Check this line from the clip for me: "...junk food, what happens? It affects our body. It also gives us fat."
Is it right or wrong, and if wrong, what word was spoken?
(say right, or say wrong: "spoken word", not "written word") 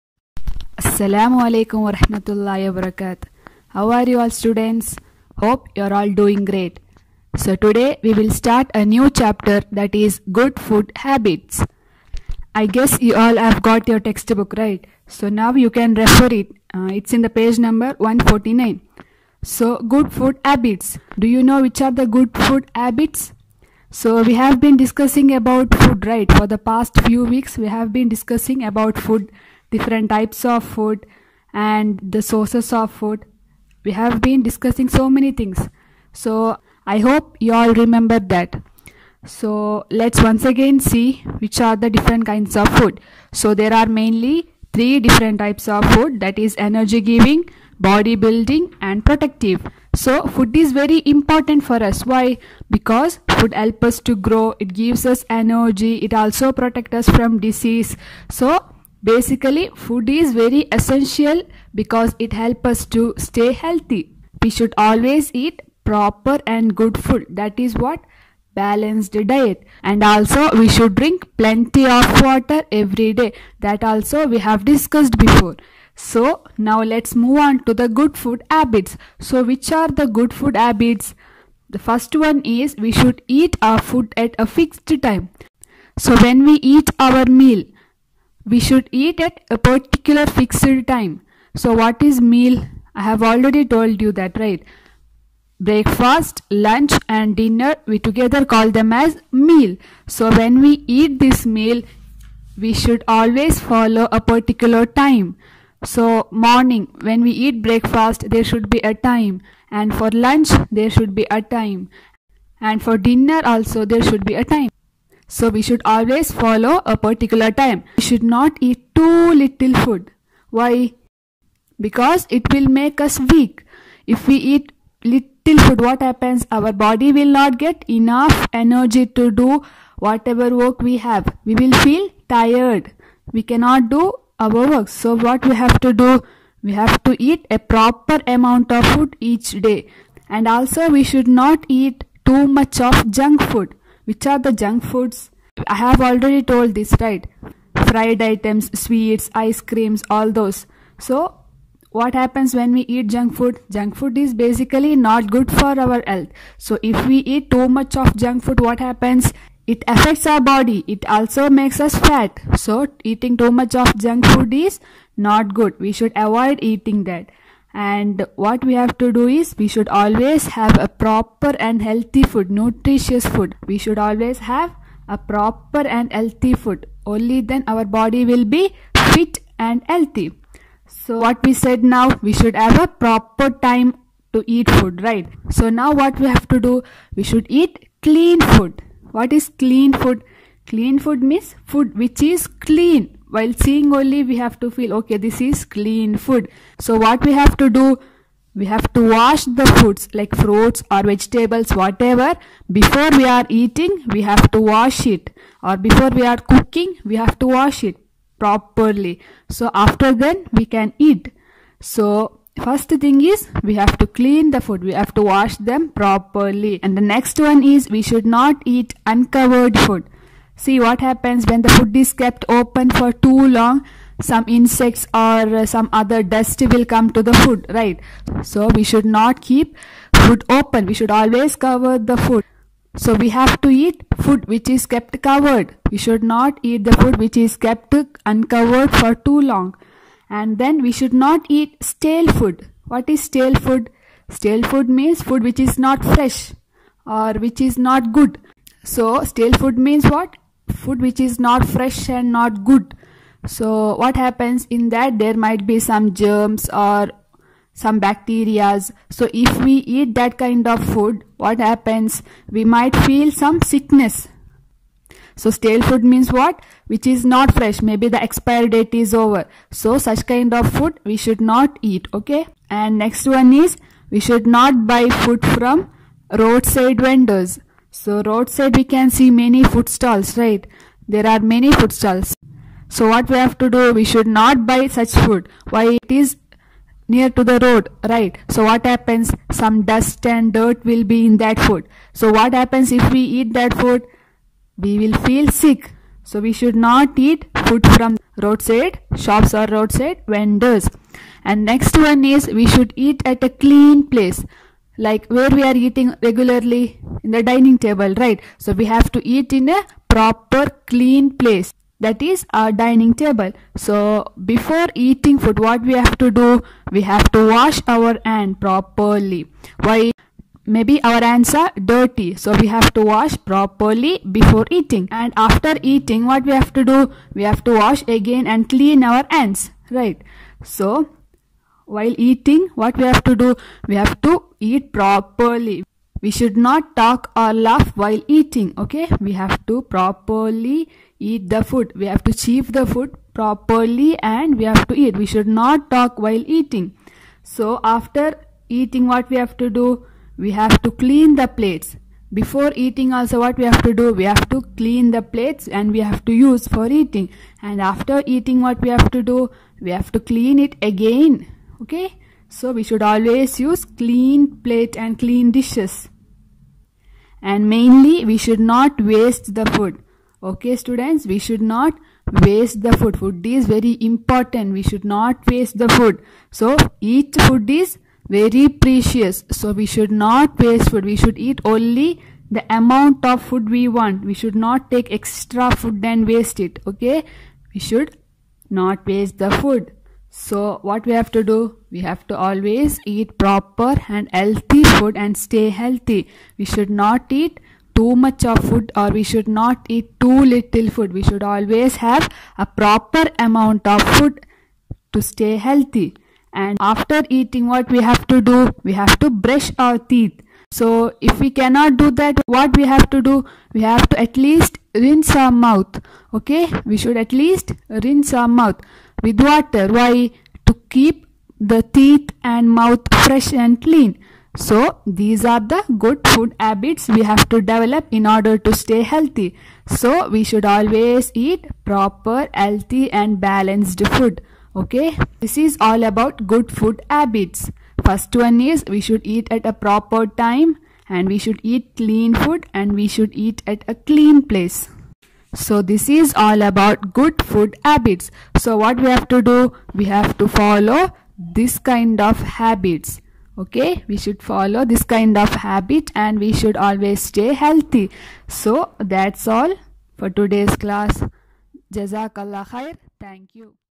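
wrong: "makes", not "gives".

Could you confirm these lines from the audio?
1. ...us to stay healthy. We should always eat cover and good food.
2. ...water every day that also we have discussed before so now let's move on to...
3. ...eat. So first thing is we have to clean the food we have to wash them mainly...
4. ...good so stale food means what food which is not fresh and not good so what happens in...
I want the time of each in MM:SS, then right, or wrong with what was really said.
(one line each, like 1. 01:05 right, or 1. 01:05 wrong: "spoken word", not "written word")
1. 01:02 wrong: "proper", not "cover"
2. 01:12 right
3. 03:30 wrong: "properly", not "mainly"
4. 04:08 right.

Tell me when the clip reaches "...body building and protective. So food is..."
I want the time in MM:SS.
00:47.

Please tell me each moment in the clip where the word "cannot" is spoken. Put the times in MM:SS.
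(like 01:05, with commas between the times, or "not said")
02:13, 06:51.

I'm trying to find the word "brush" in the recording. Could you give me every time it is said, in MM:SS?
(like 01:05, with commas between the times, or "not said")
06:49.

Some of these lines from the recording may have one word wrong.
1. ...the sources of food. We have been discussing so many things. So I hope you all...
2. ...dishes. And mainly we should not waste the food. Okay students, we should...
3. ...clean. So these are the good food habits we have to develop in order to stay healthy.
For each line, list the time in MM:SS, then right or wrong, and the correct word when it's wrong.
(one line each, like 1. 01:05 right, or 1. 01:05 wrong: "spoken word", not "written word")
1. 00:32 right
2. 06:05 right
3. 07:03 right.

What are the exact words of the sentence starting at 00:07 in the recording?
So today we will start a new chapter that is good food habits.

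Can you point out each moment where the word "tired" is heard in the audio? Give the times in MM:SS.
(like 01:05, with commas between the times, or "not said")
02:12.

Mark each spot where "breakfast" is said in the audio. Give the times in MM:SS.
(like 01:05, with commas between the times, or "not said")
01:35, 01:47.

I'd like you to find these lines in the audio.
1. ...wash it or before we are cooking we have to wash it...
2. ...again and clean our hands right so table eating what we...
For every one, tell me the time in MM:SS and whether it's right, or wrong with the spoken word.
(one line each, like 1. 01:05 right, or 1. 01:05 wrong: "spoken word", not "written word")
1. 03:24 right
2. 05:28 wrong: "while", not "table".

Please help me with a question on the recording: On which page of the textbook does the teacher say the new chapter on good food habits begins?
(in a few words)
149.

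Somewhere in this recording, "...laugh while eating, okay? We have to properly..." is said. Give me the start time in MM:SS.
05:37.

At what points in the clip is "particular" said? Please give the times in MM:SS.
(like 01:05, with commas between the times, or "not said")
01:29, 01:44, 01:56.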